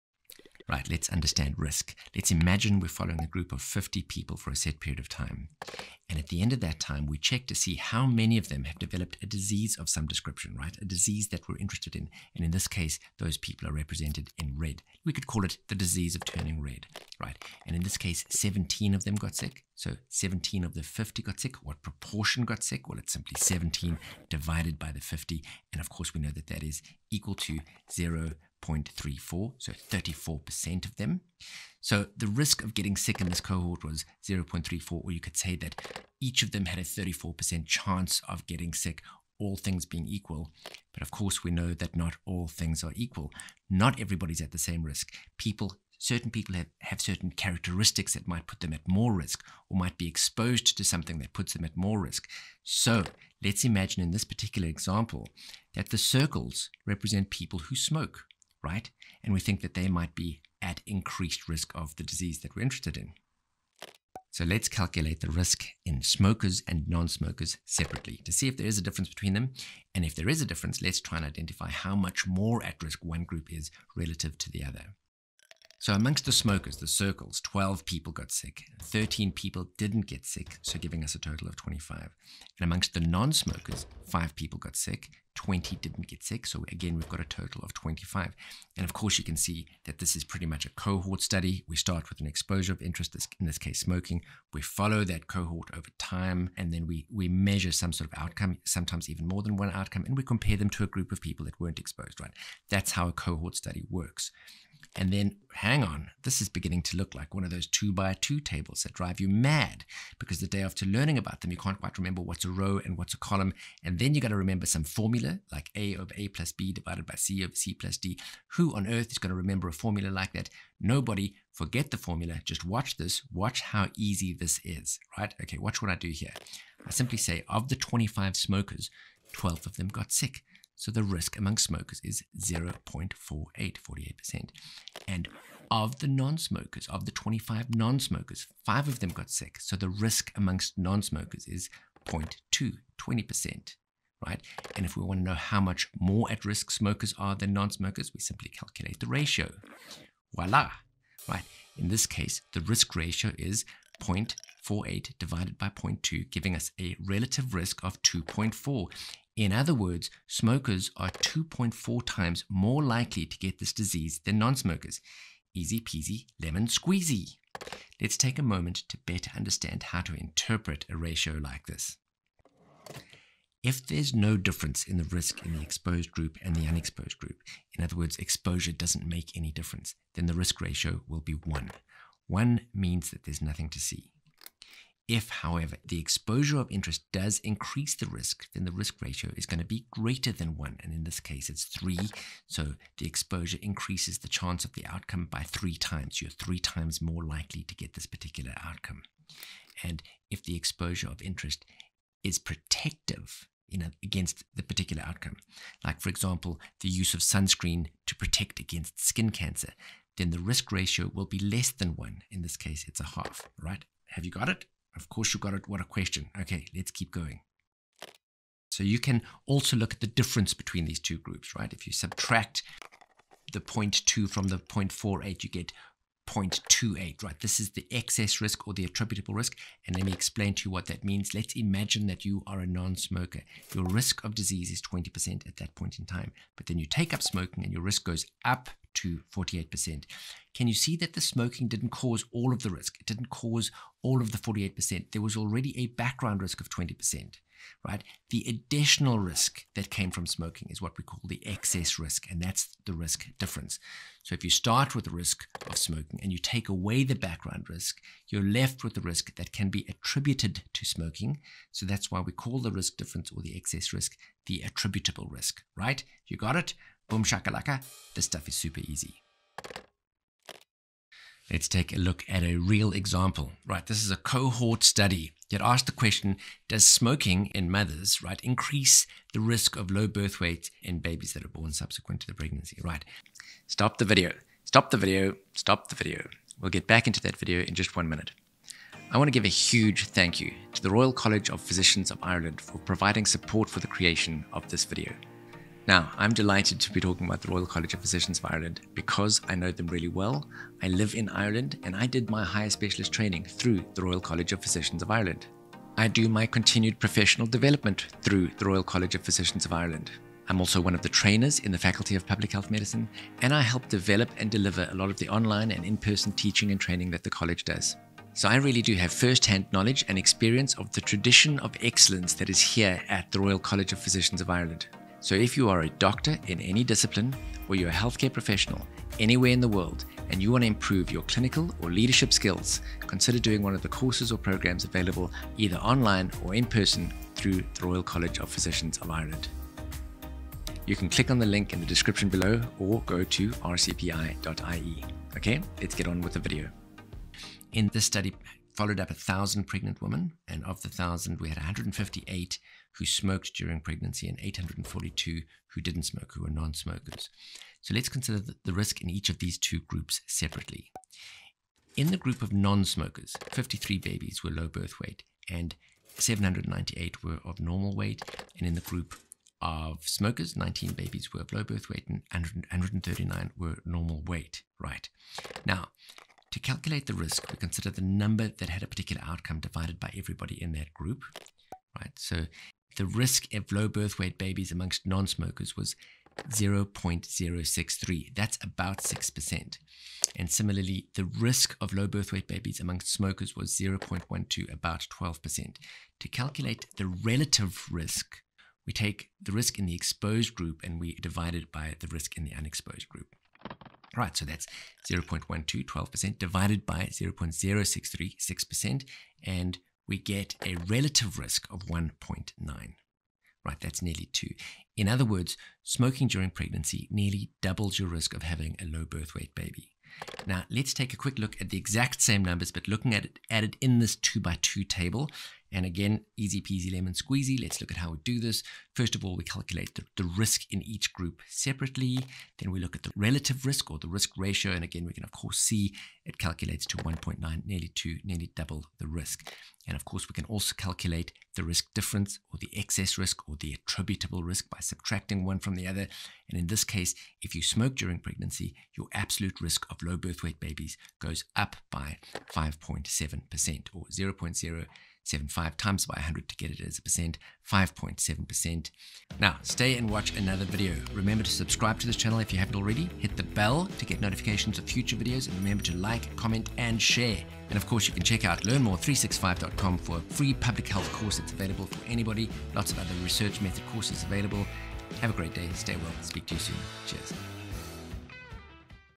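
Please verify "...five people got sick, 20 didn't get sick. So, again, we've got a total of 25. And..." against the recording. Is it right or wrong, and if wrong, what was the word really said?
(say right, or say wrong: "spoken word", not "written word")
right.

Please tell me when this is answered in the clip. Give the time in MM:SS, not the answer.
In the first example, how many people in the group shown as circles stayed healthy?
01:18.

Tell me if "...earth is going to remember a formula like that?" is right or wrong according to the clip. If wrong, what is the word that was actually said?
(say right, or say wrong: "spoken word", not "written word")
right.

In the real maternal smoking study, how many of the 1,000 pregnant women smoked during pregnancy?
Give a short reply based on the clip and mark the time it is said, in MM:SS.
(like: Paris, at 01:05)
158, at 05:51.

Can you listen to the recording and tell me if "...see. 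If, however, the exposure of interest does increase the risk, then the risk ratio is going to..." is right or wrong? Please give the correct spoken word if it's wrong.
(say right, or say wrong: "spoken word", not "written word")
right.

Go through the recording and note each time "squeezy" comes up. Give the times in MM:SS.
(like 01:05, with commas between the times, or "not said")
02:46, 07:07.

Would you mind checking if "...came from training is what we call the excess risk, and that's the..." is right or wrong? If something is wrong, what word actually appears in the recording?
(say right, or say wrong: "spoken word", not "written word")
wrong: "smoking", not "training".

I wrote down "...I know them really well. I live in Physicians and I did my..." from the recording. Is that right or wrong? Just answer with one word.
wrong.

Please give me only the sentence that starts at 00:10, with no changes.
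A disease that we're interested in.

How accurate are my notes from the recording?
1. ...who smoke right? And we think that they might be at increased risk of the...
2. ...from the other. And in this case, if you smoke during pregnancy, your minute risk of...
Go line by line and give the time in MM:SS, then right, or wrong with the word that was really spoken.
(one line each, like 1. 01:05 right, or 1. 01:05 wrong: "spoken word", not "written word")
1. 00:57 right
2. 07:25 wrong: "absolute", not "minute".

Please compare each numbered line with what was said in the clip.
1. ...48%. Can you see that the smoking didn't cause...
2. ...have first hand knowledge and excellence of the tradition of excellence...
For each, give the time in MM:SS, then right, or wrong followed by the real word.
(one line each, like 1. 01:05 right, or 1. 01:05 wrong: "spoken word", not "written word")
1. 03:59 right
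2. 05:18 wrong: "experience", not "excellence".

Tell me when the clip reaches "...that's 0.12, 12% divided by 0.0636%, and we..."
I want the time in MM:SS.
06:44.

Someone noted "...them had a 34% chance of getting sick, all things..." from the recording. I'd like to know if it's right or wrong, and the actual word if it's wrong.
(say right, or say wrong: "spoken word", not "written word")
right.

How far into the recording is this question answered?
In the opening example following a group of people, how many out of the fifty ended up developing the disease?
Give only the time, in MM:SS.
00:18.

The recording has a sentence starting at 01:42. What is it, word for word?
That's how a cohort study works.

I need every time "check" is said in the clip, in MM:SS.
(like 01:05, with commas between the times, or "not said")
00:07, 07:48.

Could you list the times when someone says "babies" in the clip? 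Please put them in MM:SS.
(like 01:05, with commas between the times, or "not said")
04:40, 06:03, 06:10, 06:24, 06:32, 07:30.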